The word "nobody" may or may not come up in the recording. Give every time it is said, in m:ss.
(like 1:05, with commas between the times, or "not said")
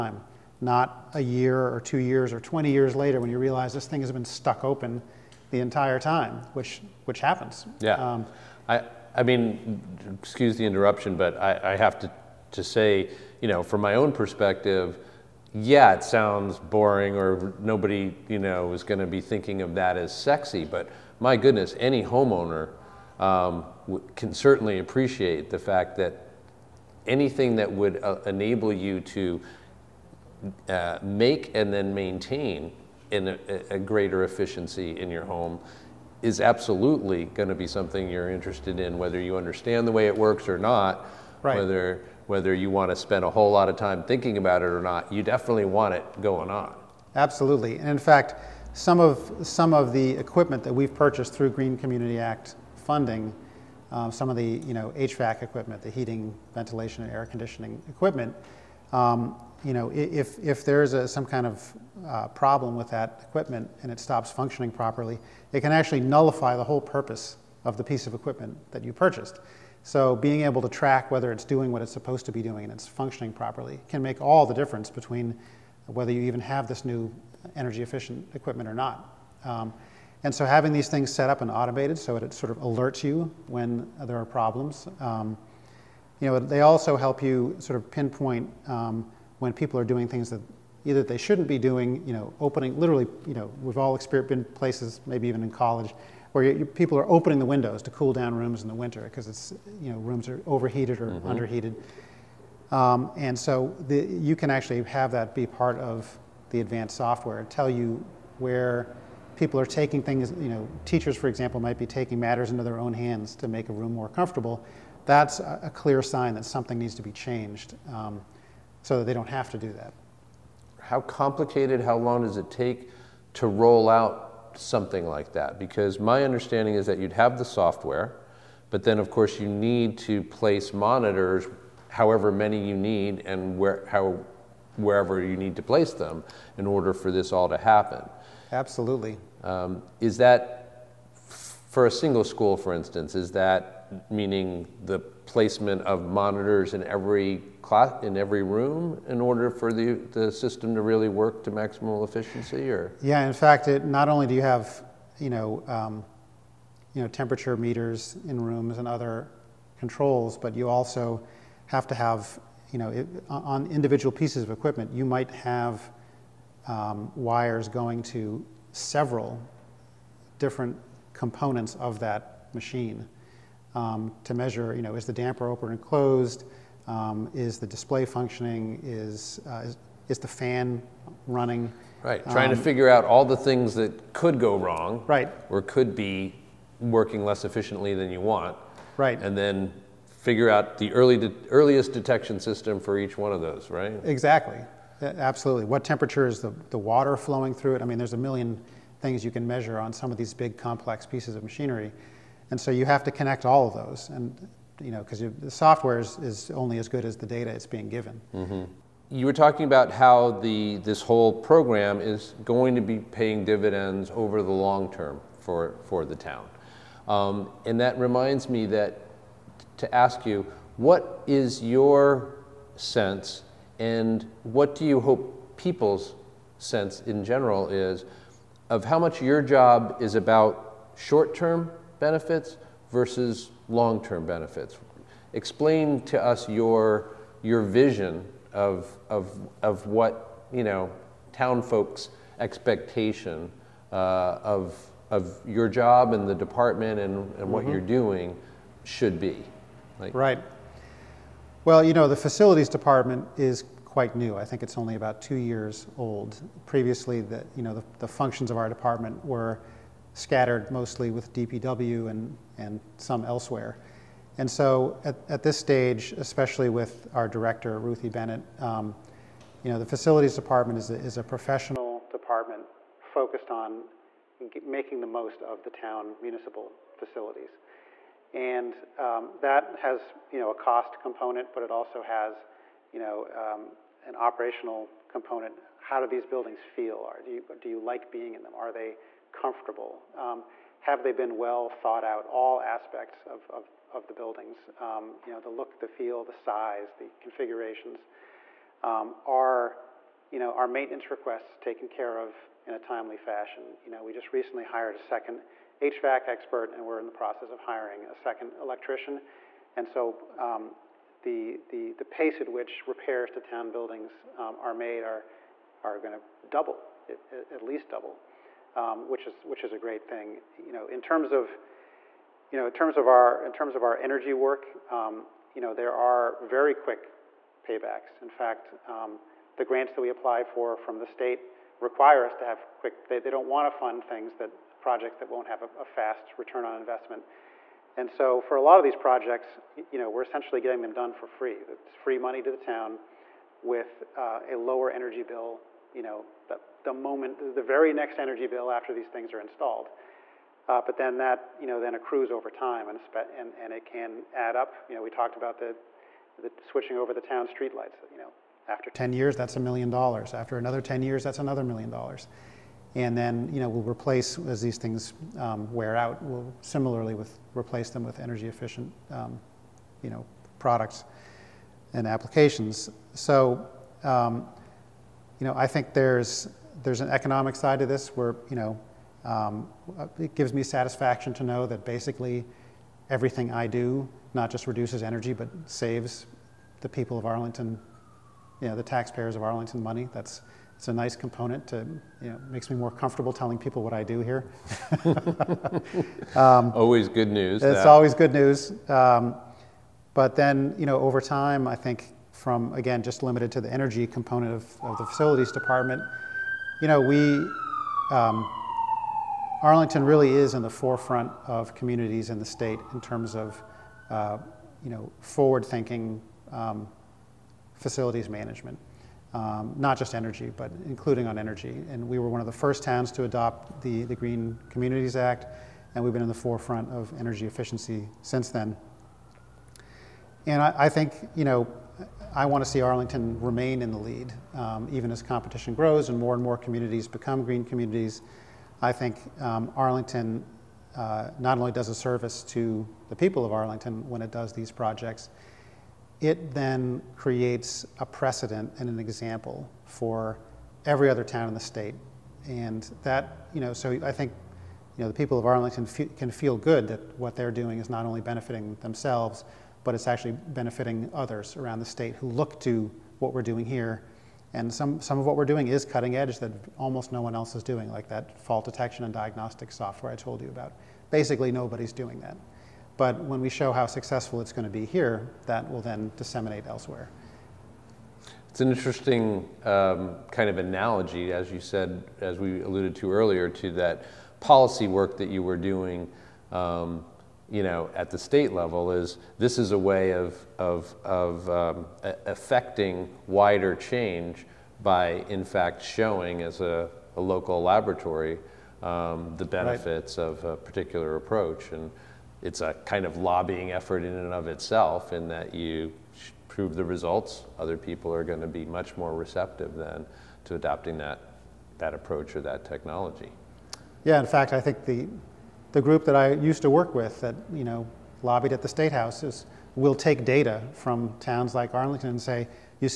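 0:17, 7:51.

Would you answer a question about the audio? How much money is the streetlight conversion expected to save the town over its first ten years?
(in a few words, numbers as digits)
a million dollars.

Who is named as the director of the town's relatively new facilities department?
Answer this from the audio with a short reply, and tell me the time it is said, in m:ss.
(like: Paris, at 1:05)
Ruthie Bennett, at 4:27.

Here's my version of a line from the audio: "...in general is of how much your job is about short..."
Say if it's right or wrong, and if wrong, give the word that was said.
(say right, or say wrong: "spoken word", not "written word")
right.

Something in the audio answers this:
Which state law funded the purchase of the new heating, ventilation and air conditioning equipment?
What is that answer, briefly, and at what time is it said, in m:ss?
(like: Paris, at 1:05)
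Green Community Act, at 0:51.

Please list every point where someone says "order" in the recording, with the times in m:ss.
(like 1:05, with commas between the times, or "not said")
2:16, 2:29.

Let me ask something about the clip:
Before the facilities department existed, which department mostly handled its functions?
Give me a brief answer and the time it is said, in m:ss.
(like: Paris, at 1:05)
DPW, at 4:21.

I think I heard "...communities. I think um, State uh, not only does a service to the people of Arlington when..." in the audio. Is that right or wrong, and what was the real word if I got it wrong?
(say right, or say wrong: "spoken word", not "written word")
wrong: "Arlington", not "State".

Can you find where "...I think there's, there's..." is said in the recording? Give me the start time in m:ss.
6:15.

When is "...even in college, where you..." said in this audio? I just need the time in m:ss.
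1:35.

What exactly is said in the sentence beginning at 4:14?
I think it's only about two years old.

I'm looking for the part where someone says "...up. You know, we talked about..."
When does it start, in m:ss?
5:54.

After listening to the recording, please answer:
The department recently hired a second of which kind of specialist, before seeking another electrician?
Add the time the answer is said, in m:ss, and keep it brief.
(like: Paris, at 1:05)
HVAC expert, at 5:05.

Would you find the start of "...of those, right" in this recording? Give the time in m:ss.
3:13.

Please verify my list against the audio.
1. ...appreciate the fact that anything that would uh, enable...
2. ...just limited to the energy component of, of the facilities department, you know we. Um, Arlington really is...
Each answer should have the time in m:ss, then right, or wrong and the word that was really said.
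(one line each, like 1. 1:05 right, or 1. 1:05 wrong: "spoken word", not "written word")
1. 0:24 right
2. 6:43 right.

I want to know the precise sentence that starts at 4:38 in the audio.
And um, that has you know, a cost component, but it also has you know, um, an operational component.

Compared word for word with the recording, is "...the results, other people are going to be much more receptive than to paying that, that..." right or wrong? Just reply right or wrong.
wrong.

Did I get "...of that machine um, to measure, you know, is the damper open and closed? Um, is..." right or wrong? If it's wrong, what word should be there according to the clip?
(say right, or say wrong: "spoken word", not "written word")
right.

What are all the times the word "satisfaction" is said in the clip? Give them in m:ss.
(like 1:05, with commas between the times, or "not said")
6:20.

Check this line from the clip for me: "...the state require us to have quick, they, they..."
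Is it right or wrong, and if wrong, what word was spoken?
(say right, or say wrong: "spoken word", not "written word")
right.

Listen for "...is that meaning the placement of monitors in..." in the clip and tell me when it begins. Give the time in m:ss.
2:23.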